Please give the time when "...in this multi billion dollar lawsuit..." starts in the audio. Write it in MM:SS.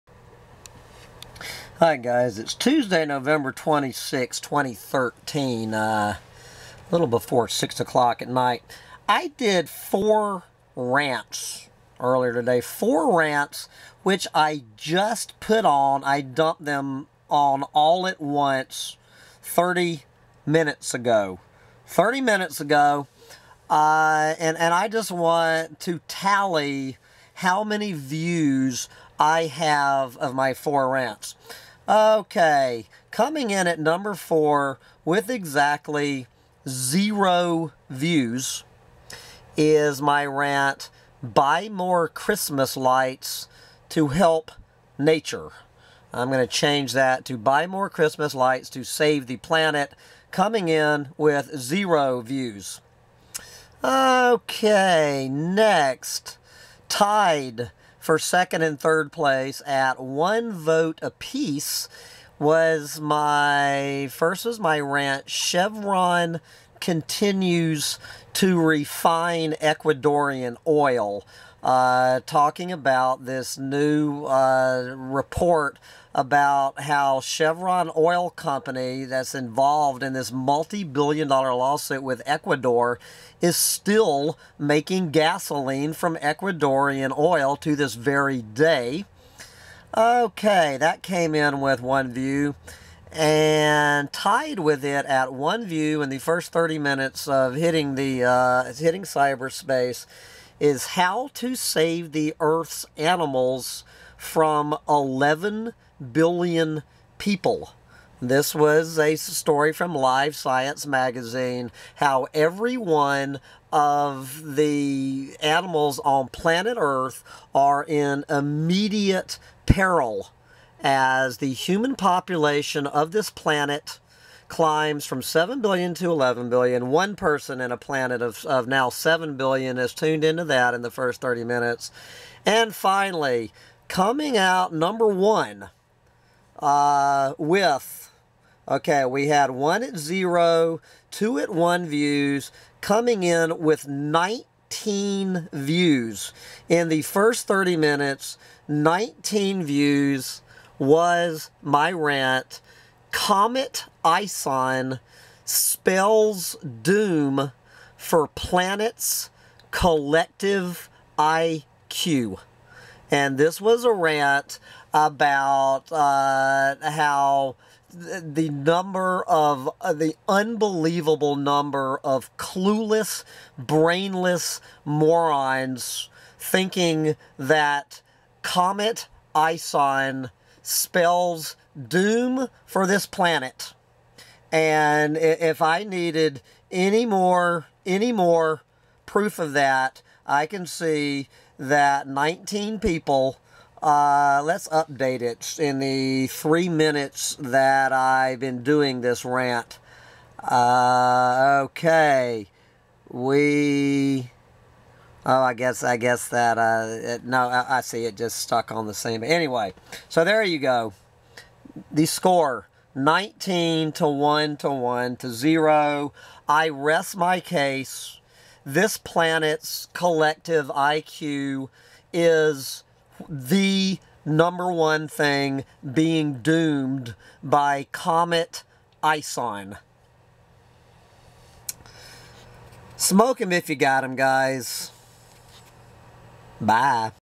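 01:20.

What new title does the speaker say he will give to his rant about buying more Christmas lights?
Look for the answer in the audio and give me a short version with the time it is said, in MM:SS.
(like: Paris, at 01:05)
Buy more Christmas lights to save the planet, at 00:47.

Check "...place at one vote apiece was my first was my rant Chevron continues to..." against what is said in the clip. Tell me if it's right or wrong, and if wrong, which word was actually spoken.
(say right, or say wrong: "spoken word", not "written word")
right.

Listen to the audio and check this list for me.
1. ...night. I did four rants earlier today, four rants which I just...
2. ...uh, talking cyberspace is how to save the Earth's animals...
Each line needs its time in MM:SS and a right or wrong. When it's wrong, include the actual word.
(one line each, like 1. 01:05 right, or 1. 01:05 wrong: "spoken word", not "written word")
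1. 00:08 right
2. 01:38 wrong: "hitting", not "talking".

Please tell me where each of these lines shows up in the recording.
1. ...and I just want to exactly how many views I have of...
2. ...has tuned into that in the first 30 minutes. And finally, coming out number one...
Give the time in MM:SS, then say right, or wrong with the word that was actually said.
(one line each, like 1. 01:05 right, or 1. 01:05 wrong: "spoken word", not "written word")
1. 00:24 wrong: "tally", not "exactly"
2. 02:09 right.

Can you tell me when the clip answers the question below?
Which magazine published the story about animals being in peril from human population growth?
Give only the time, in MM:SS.
01:49.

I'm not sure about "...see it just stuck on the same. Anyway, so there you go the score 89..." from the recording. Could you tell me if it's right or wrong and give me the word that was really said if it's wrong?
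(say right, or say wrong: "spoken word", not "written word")
wrong: "19", not "89".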